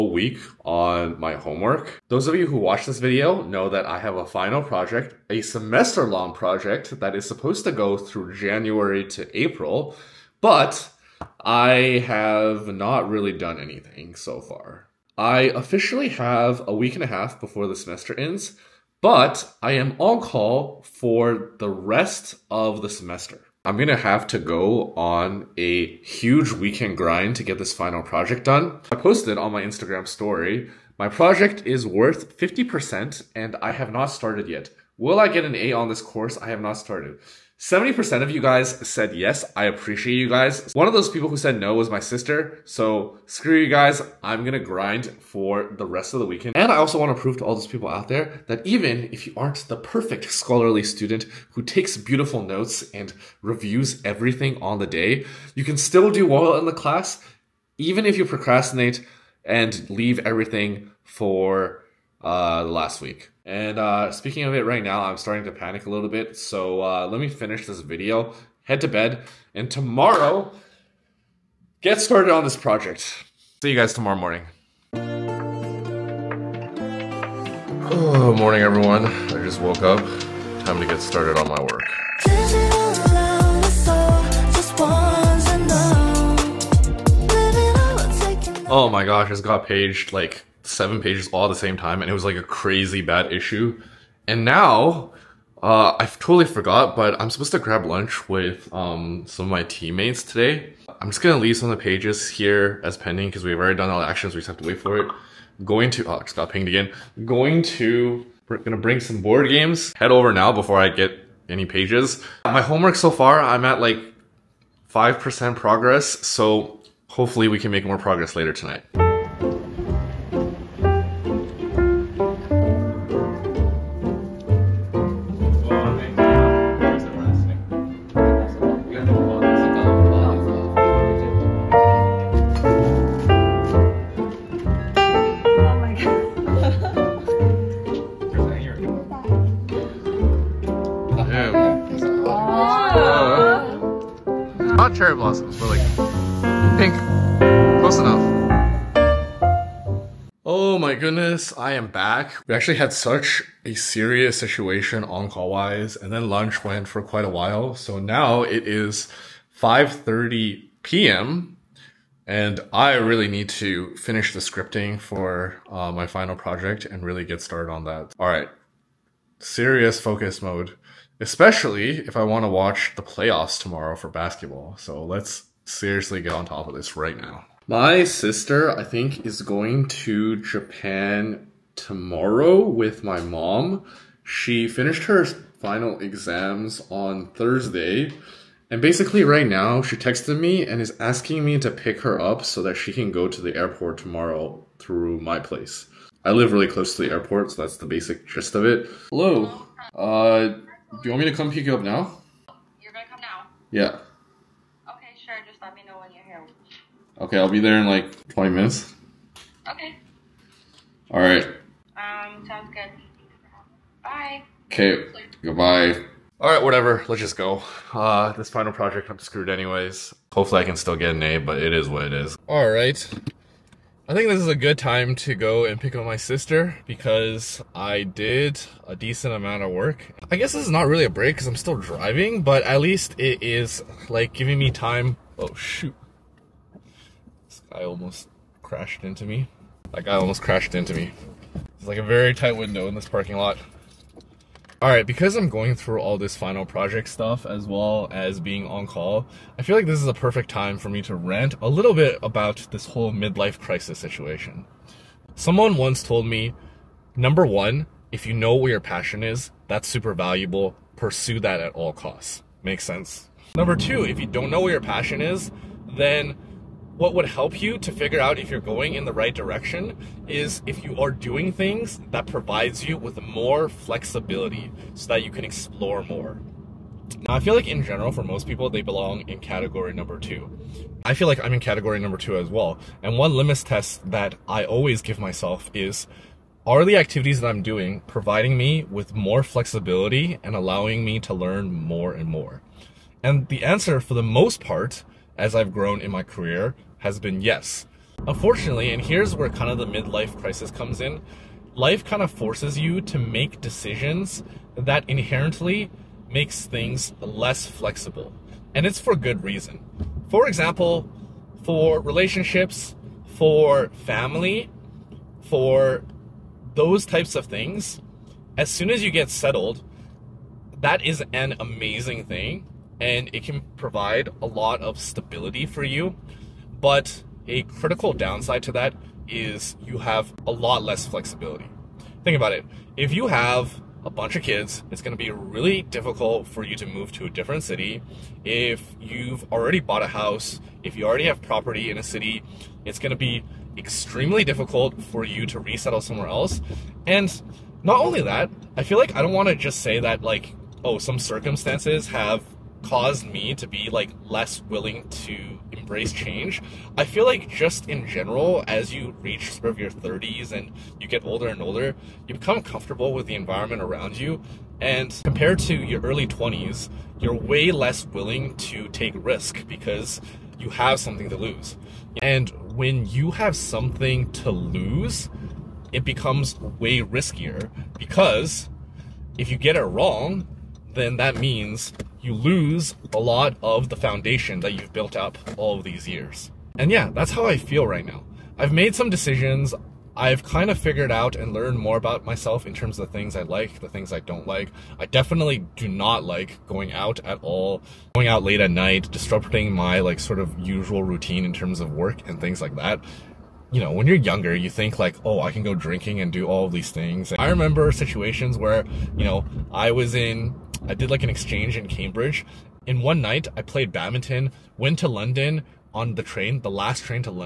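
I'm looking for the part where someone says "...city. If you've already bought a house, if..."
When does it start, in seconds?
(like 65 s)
337 s.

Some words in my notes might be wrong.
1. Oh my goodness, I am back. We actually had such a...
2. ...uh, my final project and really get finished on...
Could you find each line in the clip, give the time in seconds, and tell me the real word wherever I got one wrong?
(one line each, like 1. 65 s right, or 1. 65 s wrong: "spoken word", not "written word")
1. 150 s right
2. 165 s wrong: "started", not "finished".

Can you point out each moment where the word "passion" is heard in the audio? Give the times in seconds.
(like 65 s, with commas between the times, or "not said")
258 s, 264 s.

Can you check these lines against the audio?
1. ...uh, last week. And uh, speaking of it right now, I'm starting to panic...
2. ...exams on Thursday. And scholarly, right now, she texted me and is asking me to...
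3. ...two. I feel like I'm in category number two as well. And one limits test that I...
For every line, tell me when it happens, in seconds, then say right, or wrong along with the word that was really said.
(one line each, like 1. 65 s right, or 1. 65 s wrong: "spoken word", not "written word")
1. 62 s right
2. 185 s wrong: "basically", not "scholarly"
3. 280 s right.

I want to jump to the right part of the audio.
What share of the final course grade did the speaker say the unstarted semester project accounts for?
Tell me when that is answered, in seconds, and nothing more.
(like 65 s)
32 s.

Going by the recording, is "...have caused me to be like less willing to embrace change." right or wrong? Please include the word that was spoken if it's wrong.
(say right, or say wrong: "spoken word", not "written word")
right.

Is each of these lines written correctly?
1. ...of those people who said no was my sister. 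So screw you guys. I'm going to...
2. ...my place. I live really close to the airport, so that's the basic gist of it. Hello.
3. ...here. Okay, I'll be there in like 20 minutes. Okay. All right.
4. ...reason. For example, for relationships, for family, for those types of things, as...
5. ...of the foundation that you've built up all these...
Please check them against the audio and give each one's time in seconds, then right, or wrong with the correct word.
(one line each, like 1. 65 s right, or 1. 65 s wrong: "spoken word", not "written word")
1. 40 s right
2. 195 s right
3. 206 s right
4. 309 s right
5. 383 s right.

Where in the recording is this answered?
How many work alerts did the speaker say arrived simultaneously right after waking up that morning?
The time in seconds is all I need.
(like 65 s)
90 s.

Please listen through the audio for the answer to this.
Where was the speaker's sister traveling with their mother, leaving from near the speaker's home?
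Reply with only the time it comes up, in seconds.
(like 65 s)
180 s.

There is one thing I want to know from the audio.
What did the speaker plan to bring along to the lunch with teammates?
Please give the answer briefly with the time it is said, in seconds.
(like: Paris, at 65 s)
board games, at 109 s.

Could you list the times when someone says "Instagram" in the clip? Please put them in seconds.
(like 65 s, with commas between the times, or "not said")
29 s.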